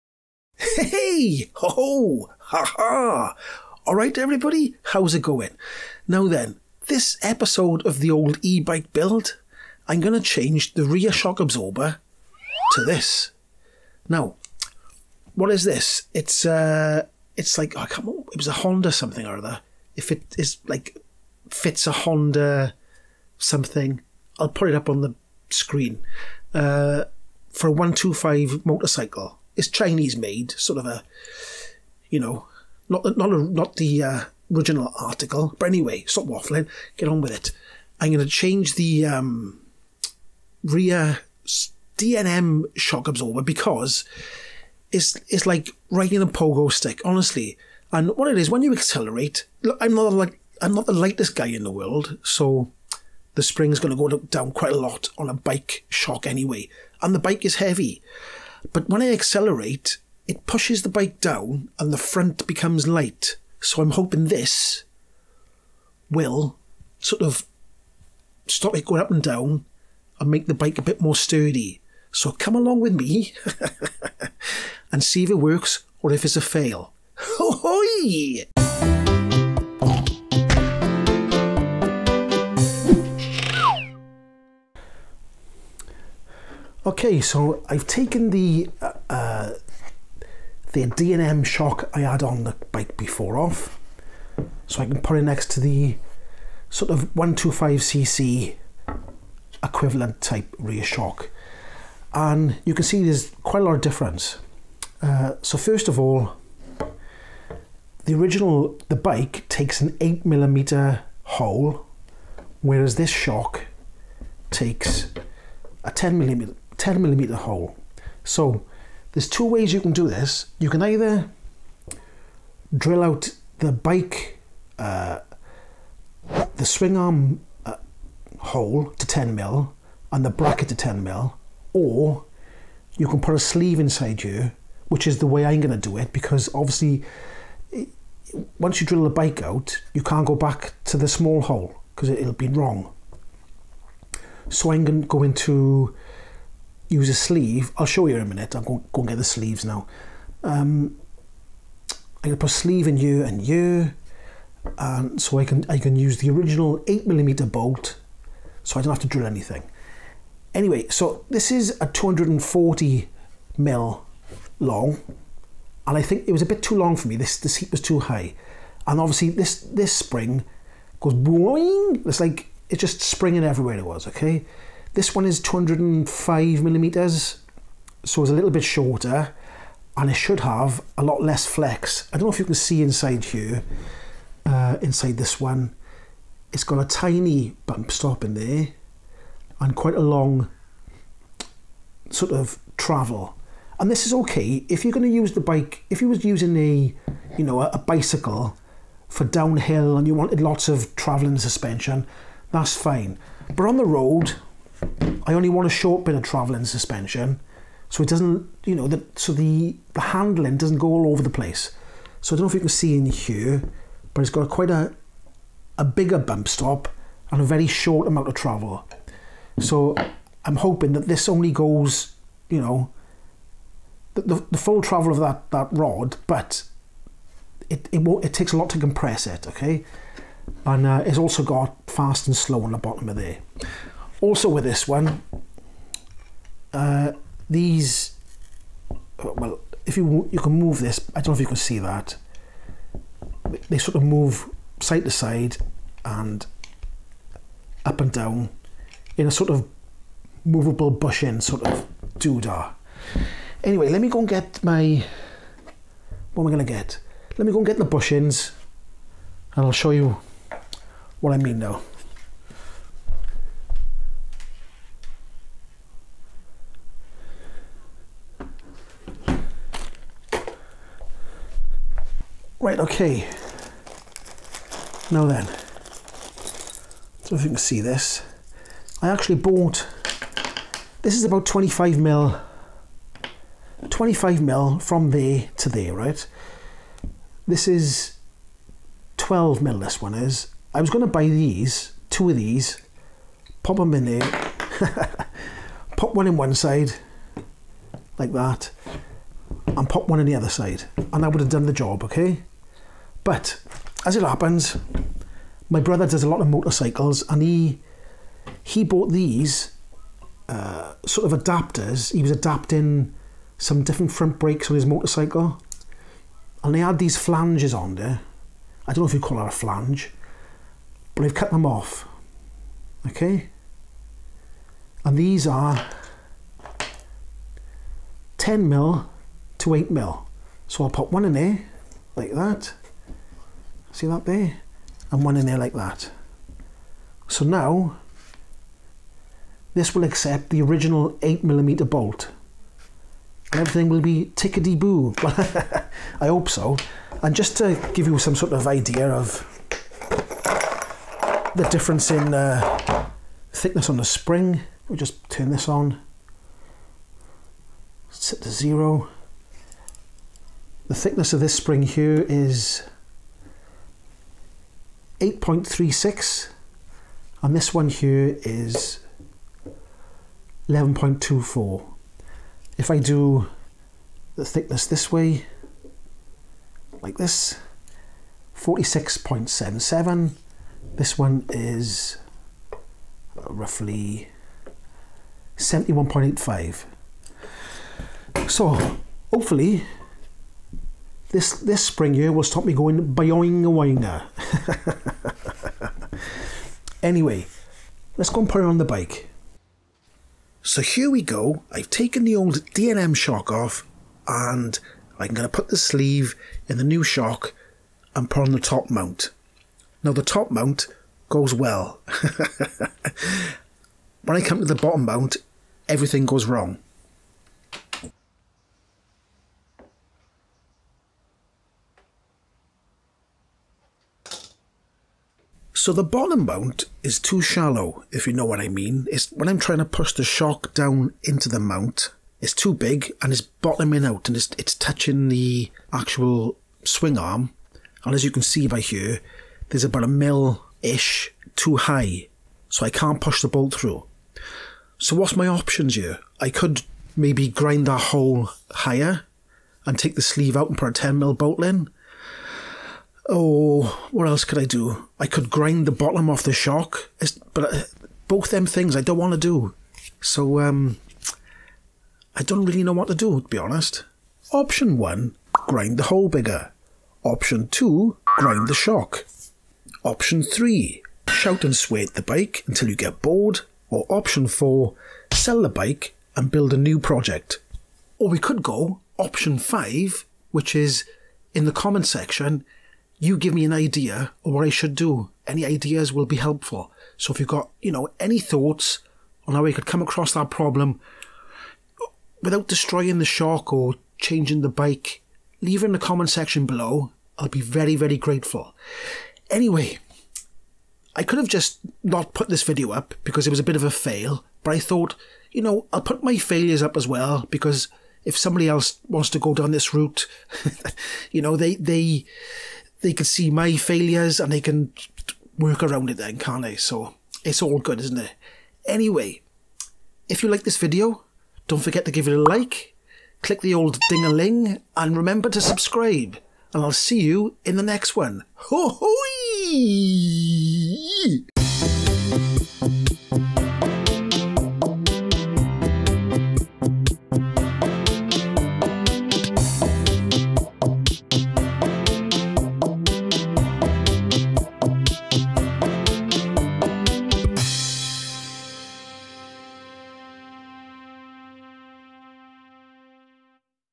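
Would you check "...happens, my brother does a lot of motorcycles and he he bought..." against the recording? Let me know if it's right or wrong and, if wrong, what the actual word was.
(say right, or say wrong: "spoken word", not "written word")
right.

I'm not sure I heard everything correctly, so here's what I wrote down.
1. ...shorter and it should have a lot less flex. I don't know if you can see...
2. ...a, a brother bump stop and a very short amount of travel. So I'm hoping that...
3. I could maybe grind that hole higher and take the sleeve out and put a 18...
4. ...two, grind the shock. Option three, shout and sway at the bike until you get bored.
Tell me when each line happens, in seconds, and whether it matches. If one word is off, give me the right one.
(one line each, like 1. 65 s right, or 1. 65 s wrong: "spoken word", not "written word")
1. 178 s right
2. 214 s wrong: "bigger", not "brother"
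3. 446 s wrong: "10", not "18"
4. 467 s right.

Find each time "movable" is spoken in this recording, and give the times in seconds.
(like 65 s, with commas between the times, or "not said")
250 s.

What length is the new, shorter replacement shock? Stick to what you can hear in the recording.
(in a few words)
205 millimeters.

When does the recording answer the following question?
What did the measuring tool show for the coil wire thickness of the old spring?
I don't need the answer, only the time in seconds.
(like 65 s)
365 s.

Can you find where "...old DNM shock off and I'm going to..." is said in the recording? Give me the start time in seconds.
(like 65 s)
402 s.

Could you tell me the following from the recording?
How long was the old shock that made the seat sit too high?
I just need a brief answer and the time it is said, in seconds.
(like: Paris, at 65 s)
240 mm, at 161 s.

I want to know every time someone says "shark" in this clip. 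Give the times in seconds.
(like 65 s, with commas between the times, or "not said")
493 s.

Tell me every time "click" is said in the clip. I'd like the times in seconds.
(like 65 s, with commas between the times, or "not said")
523 s.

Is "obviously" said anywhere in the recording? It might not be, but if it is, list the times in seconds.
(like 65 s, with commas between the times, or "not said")
136 s, 168 s.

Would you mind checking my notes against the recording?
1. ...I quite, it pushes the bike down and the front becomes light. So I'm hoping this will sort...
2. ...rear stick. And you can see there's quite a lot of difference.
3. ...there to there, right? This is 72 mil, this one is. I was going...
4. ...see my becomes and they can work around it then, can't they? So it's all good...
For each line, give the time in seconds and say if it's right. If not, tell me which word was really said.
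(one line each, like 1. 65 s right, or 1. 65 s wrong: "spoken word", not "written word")
1. 59 s wrong: "accelerate", not "quite"
2. 100 s wrong: "shock", not "stick"
3. 285 s wrong: "12", not "72"
4. 513 s wrong: "failures", not "becomes".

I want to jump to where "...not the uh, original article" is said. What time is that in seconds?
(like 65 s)
33 s.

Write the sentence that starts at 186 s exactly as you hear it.
It's got a tiny bump stop in there and quite a long sort of travel.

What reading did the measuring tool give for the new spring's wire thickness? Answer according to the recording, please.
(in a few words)
11.24.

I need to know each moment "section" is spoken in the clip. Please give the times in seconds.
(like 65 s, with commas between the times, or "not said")
482 s, 496 s.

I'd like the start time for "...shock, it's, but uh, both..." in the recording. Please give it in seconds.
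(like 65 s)
456 s.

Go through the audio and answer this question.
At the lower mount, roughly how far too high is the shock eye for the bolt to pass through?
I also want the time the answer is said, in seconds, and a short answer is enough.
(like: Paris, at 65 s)
a mil-ish, at 440 s.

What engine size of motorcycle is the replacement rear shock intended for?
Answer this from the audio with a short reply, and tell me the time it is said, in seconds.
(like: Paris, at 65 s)
125, at 27 s.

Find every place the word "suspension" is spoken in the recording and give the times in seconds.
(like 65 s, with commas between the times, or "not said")
201 s, 206 s.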